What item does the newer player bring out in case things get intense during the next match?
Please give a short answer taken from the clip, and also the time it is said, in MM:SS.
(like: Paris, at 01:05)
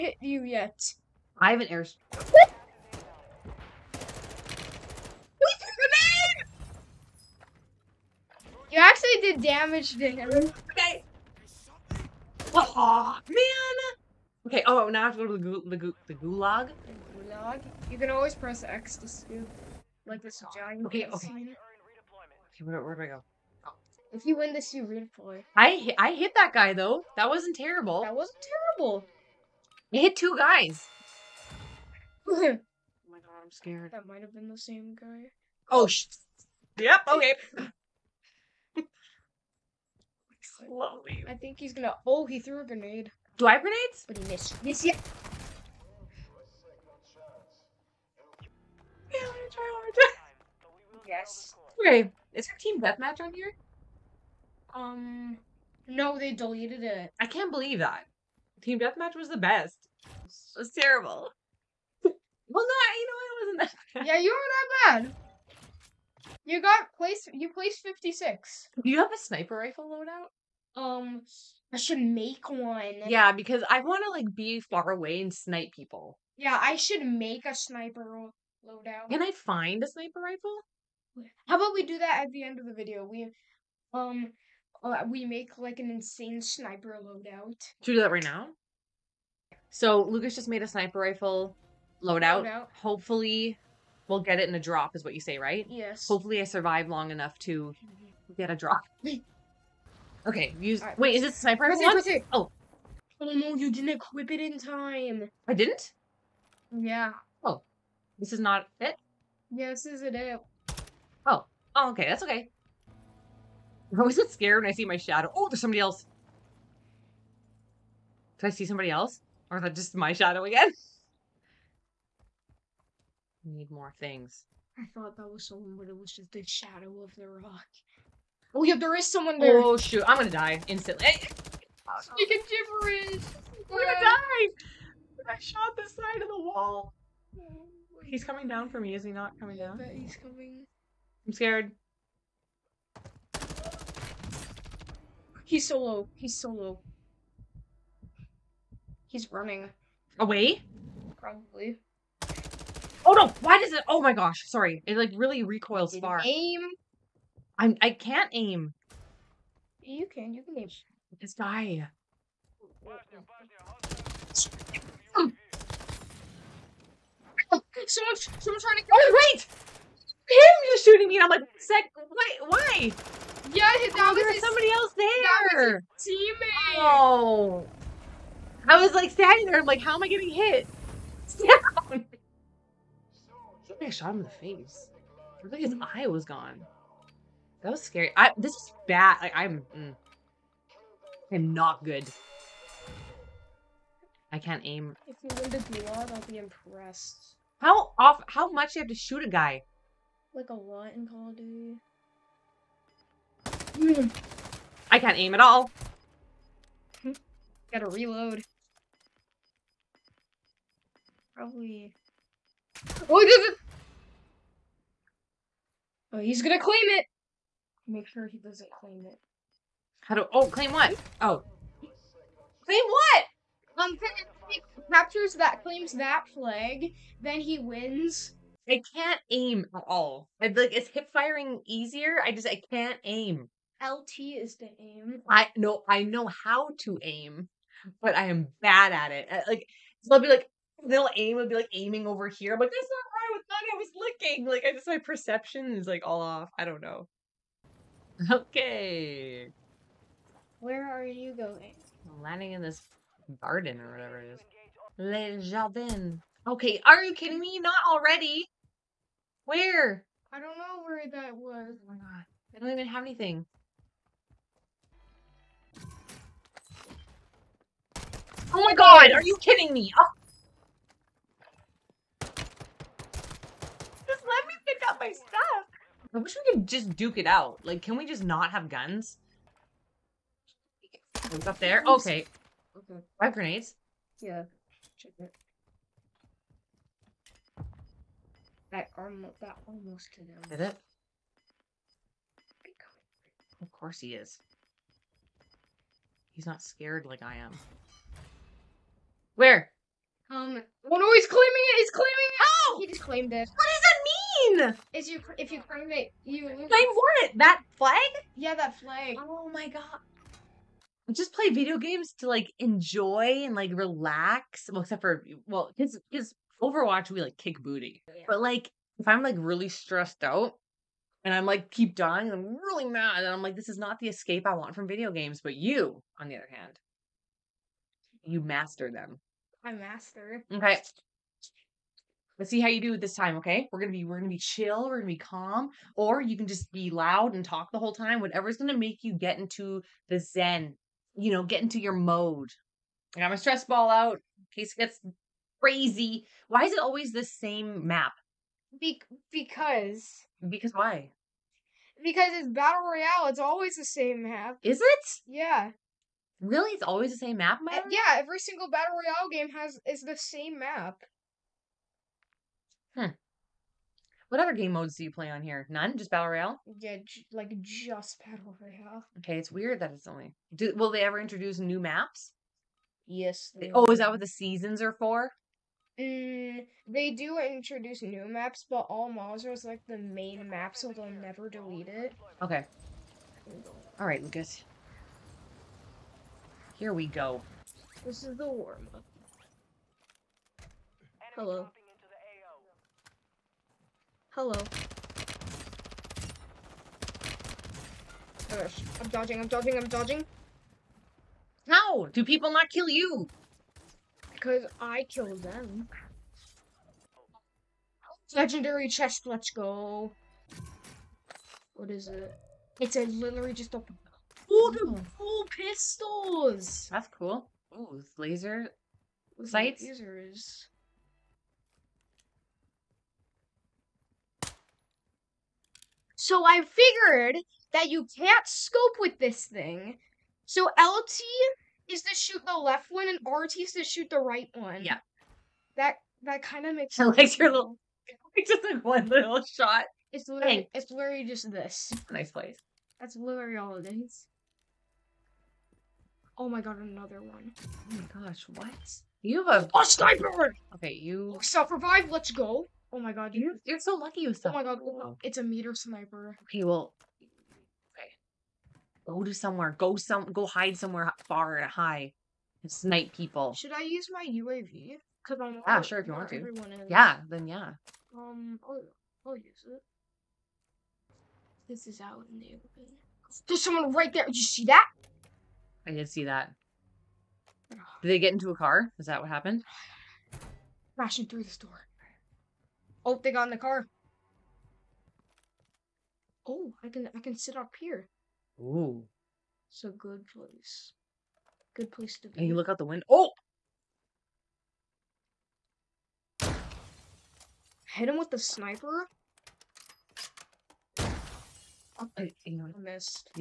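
Stress ball, at 05:43.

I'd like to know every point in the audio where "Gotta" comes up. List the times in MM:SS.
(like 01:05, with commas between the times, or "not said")
03:27.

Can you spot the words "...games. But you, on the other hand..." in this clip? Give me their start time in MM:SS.
05:25.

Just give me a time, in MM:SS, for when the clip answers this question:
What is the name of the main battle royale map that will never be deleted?
06:18.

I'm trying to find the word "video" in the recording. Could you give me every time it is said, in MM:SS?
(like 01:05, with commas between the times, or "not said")
01:22, 05:11, 05:24.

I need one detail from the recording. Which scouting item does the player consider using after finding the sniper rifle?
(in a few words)
UAV.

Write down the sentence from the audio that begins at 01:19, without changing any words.
Can I find a sniper rifle?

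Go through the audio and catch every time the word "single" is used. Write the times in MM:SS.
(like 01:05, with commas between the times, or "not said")
05:58.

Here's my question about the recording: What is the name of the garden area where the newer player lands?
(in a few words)
Le Jardin.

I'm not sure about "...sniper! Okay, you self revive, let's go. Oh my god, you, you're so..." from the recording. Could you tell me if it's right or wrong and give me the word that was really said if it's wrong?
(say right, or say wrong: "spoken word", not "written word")
right.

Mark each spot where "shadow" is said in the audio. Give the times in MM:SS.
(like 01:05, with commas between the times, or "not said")
01:54, 02:00, 02:06.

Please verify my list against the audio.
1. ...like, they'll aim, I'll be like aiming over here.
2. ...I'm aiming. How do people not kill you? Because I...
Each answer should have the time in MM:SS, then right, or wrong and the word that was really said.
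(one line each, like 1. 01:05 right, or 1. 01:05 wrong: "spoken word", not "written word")
1. 04:00 right
2. 06:39 wrong: "dodging", not "aiming".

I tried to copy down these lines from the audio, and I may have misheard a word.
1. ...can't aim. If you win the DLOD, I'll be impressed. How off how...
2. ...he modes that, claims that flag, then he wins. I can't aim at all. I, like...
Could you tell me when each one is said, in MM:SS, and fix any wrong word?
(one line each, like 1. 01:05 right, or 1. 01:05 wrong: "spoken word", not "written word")
1. 03:14 right
2. 03:44 wrong: "captures", not "modes".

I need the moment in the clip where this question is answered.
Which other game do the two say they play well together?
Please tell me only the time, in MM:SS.
05:16.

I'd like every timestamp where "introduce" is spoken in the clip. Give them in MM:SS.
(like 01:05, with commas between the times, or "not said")
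06:11, 06:17.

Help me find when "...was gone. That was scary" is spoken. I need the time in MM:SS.
03:06.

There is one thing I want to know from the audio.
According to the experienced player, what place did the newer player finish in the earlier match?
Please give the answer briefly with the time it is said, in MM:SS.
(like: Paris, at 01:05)
56, at 01:07.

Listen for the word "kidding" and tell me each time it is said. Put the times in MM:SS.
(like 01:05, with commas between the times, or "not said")
04:17, 04:29.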